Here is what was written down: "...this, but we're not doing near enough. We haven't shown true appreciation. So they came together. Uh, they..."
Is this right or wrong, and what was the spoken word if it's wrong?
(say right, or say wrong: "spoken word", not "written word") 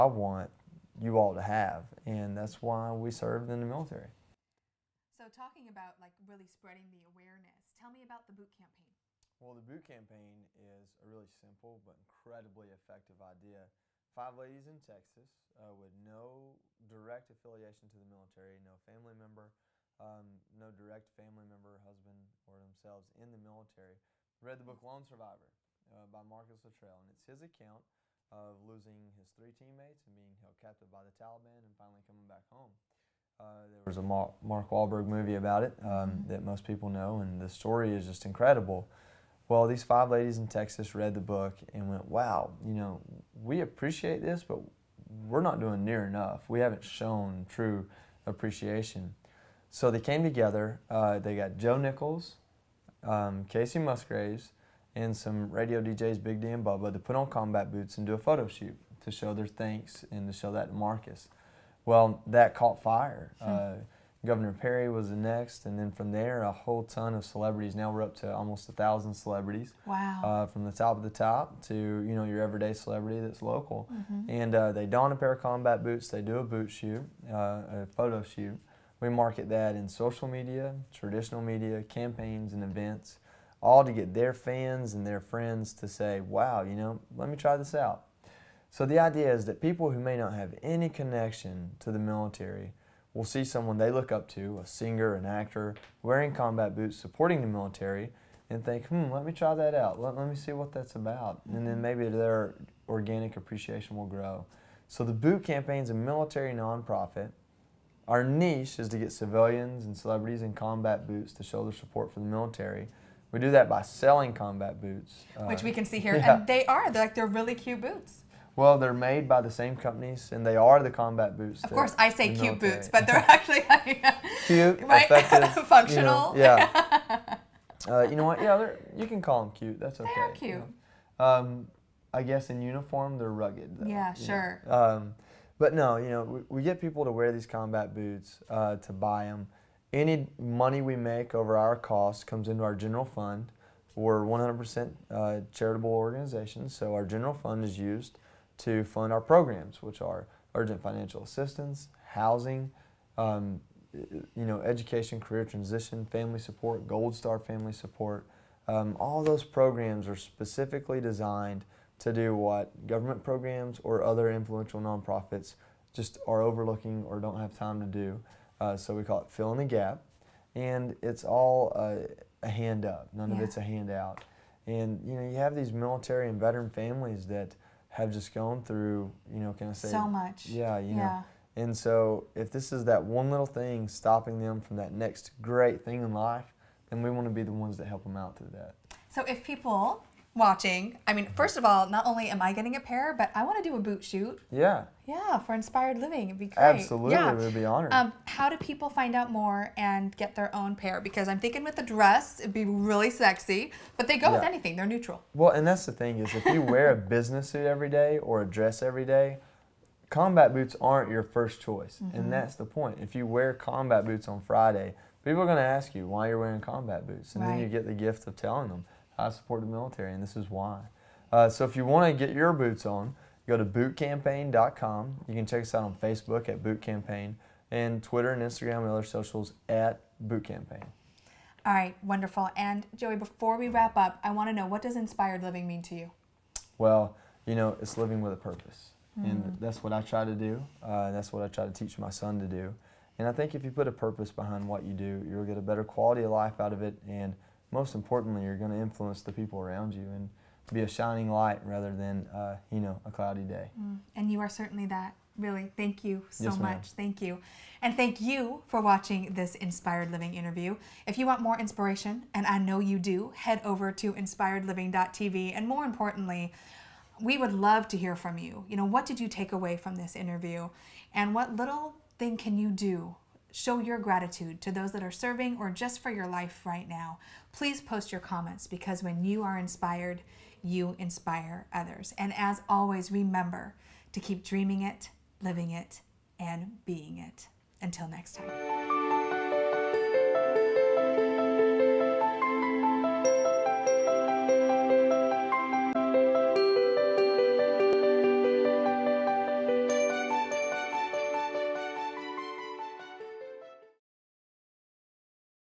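right.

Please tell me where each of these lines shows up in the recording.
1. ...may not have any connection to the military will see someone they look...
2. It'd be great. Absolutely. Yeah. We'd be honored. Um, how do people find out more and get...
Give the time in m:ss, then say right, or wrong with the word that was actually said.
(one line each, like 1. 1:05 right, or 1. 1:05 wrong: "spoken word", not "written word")
1. 1:29 right
2. 3:16 right.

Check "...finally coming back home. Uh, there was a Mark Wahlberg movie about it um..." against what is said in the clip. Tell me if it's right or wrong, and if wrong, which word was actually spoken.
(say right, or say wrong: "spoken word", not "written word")
right.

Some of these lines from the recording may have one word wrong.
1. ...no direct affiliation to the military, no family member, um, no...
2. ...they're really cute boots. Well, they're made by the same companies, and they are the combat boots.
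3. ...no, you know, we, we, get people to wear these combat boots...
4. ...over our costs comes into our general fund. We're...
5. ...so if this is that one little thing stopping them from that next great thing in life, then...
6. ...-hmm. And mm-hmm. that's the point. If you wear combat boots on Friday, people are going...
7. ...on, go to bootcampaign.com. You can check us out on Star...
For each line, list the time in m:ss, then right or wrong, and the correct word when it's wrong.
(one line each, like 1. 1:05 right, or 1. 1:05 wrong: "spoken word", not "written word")
1. 0:15 right
2. 1:57 right
3. 2:15 right
4. 2:21 right
5. 3:01 right
6. 3:32 right
7. 3:42 wrong: "Facebook", not "Star".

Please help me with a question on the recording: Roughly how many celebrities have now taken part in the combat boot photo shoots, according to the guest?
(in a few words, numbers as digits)
almost 1,000.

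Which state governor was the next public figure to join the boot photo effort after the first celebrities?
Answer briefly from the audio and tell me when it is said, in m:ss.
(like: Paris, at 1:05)
Governor Perry, at 1:04.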